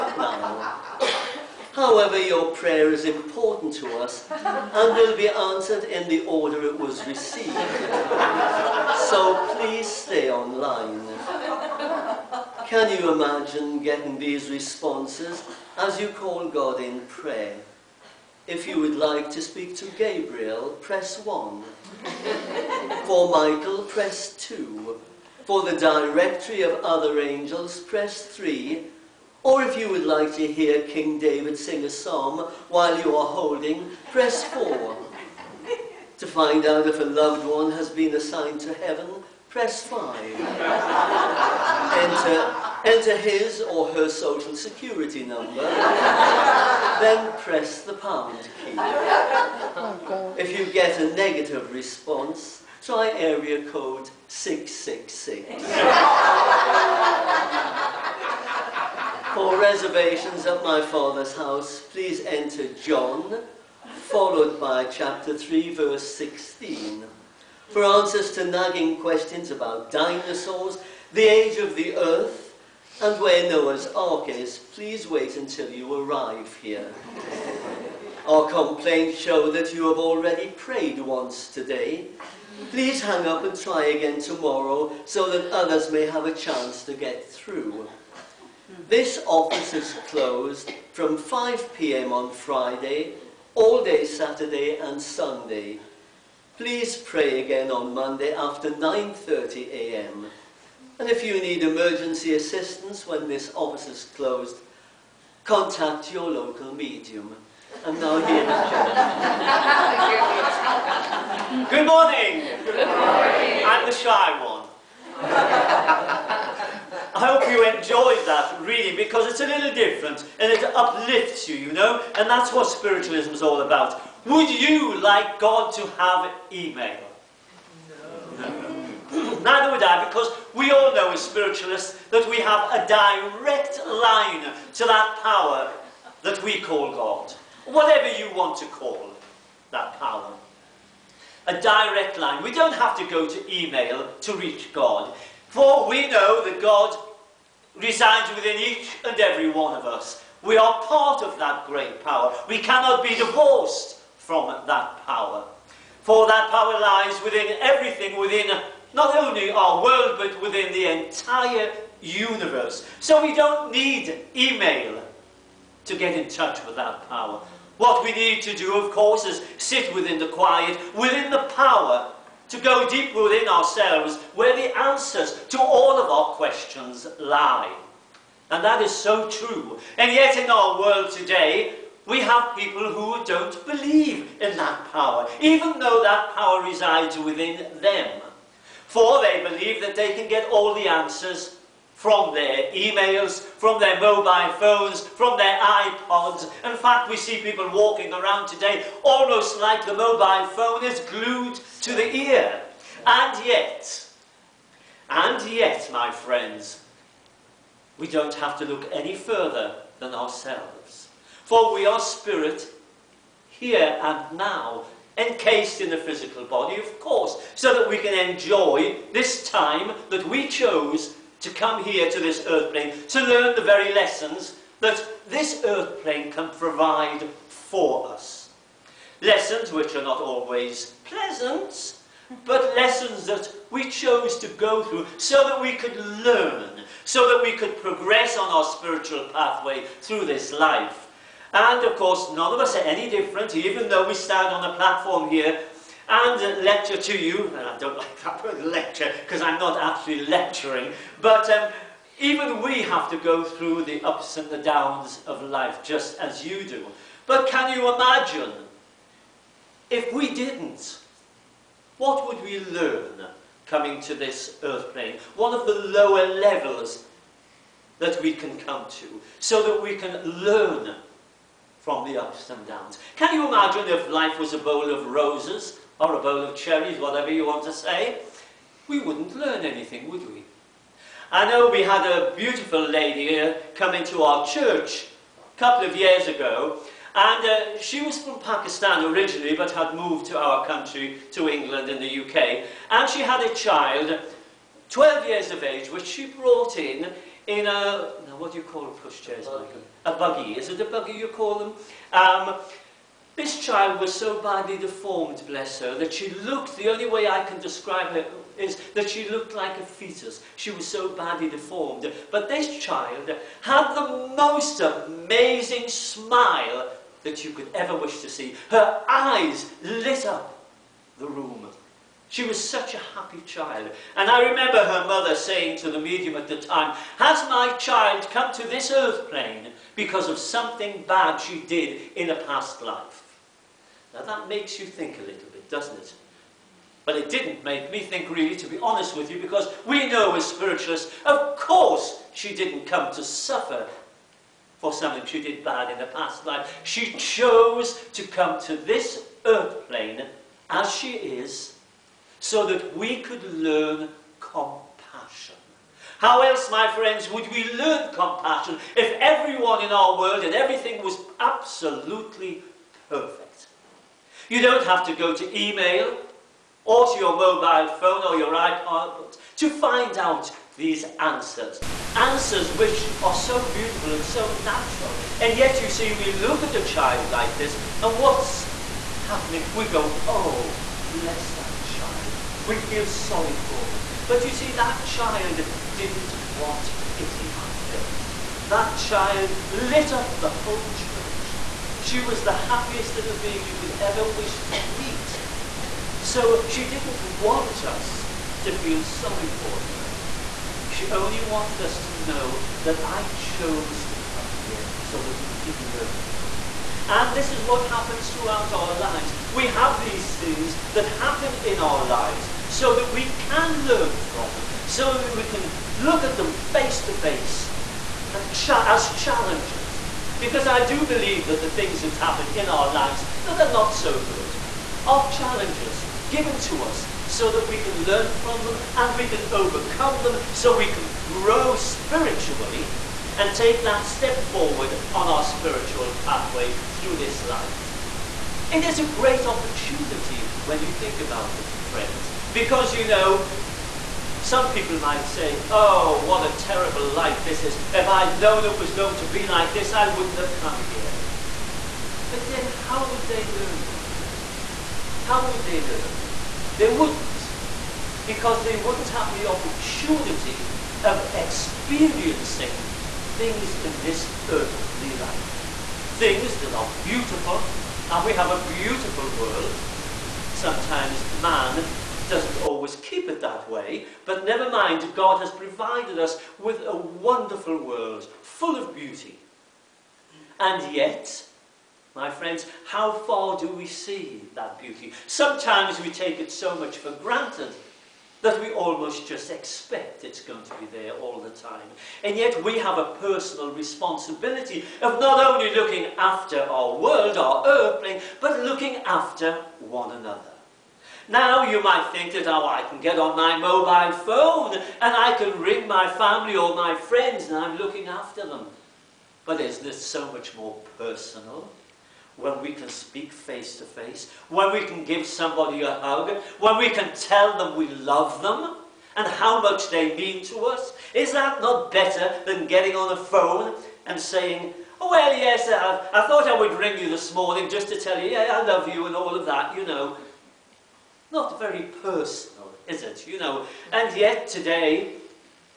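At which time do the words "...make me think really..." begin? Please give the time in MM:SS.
05:37.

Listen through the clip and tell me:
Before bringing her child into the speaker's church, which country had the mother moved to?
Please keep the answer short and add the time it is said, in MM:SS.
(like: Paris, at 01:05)
England, at 04:51.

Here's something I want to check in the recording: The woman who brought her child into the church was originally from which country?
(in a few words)
Pakistan.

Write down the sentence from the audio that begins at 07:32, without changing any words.
But then how would they learn, my friends?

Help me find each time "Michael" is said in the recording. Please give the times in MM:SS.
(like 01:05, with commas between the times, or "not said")
00:23, 04:59.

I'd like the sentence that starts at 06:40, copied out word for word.
She only wanted us to know that I chose to come here so that you could learn from me.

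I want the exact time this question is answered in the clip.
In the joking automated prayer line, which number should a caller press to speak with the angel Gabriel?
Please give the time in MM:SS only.
00:21.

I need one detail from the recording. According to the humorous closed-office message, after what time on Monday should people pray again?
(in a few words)
9:30 a.m.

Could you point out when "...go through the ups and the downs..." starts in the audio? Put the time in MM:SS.
04:13.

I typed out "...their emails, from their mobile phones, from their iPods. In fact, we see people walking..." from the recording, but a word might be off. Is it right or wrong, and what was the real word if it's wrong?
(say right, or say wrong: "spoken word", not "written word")
right.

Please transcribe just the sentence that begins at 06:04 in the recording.
You don't have to go to email or to your mobile phone or your iPod to find out these answers.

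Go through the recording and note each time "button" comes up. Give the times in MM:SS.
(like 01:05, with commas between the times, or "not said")
not said.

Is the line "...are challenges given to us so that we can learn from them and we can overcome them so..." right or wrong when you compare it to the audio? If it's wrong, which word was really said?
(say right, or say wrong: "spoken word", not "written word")
right.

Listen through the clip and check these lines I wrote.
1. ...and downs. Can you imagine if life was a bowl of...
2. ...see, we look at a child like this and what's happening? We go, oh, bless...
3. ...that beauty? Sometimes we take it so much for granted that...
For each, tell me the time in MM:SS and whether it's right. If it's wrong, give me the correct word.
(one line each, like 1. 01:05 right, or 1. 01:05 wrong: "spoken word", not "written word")
1. 04:32 right
2. 06:15 right
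3. 08:04 right.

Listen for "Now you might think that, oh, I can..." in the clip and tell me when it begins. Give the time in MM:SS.
08:21.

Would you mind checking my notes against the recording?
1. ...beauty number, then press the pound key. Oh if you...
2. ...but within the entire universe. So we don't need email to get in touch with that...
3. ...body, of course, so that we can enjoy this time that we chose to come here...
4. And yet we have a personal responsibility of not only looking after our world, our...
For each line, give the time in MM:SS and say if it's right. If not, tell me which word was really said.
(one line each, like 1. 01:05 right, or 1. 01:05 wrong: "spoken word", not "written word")
1. 00:44 wrong: "security", not "beauty"
2. 02:40 right
3. 03:36 right
4. 08:12 right.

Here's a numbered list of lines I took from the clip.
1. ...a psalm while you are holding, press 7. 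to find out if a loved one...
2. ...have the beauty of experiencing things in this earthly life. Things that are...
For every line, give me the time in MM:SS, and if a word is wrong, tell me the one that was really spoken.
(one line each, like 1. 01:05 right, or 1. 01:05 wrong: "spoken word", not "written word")
1. 00:31 wrong: "4", not "7"
2. 07:39 wrong: "opportunity", not "beauty".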